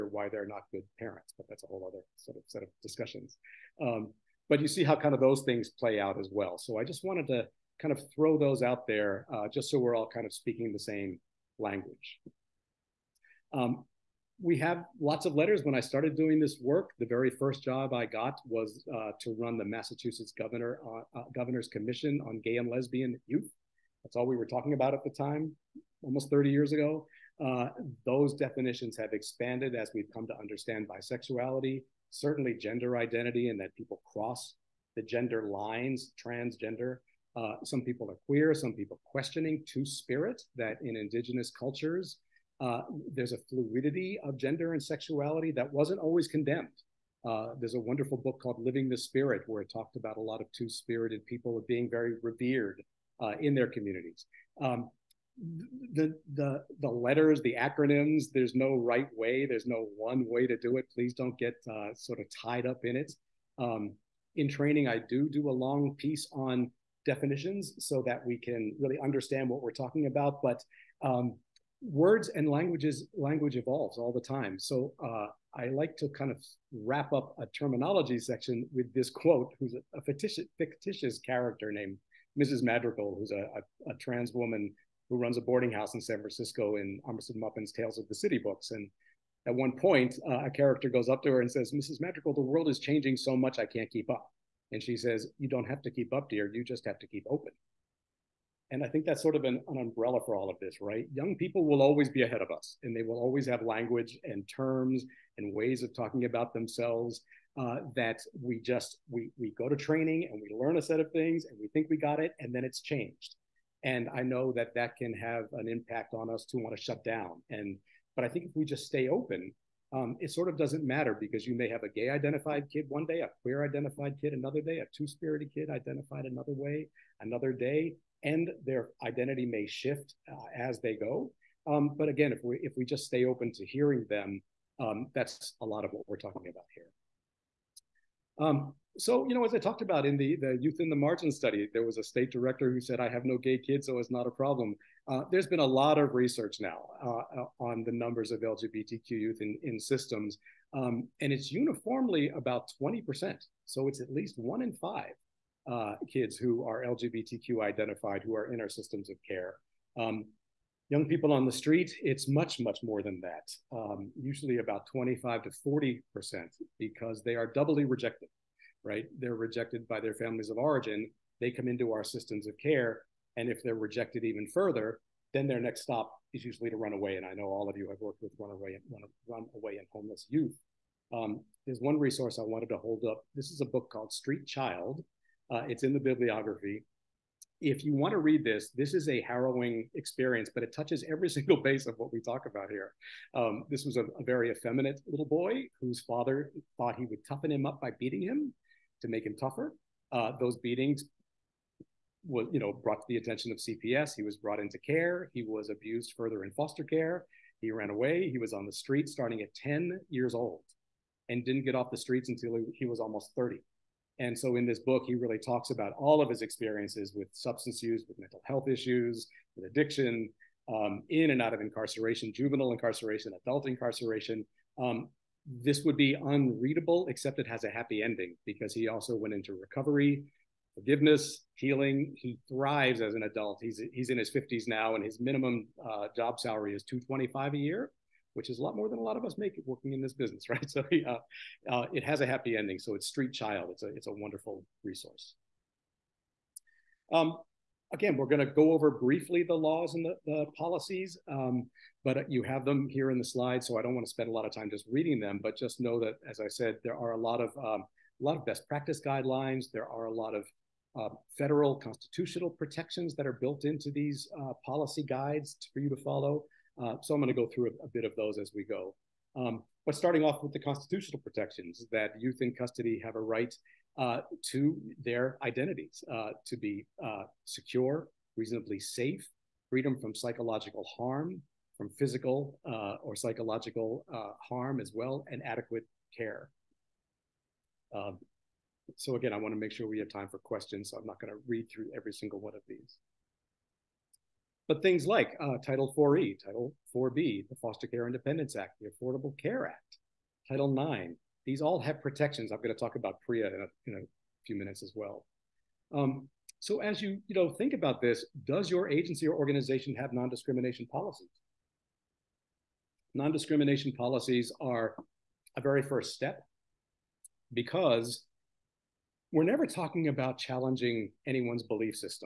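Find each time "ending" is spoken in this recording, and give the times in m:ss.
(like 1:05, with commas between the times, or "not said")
3:48, 4:02.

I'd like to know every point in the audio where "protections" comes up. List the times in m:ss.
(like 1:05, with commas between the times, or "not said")
4:22, 4:31, 5:02.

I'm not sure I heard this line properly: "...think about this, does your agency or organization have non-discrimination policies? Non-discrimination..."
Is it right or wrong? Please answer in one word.
right.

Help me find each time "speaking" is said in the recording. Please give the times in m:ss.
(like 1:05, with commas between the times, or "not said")
0:10.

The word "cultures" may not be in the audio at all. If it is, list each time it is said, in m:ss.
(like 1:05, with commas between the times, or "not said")
0:41.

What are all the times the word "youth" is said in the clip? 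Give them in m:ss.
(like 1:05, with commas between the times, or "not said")
0:23, 2:20, 2:29, 3:00, 4:32.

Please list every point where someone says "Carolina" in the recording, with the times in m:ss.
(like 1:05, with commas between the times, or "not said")
not said.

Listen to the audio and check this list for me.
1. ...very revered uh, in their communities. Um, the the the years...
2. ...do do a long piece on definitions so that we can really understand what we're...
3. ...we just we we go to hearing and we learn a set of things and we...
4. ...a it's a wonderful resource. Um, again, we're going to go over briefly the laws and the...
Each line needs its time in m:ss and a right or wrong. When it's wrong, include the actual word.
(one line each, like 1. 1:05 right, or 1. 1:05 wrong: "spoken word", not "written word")
1. 0:51 wrong: "letters", not "years"
2. 1:04 right
3. 1:48 wrong: "training", not "hearing"
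4. 4:03 right.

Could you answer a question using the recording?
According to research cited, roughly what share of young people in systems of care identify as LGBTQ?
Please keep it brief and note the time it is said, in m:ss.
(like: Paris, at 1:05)
20%, at 2:32.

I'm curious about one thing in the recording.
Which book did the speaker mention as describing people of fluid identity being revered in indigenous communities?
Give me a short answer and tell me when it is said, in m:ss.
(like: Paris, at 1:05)
Living the Spirit, at 0:48.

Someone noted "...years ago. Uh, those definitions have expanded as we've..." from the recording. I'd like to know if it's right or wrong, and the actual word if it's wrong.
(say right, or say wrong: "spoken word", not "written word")
right.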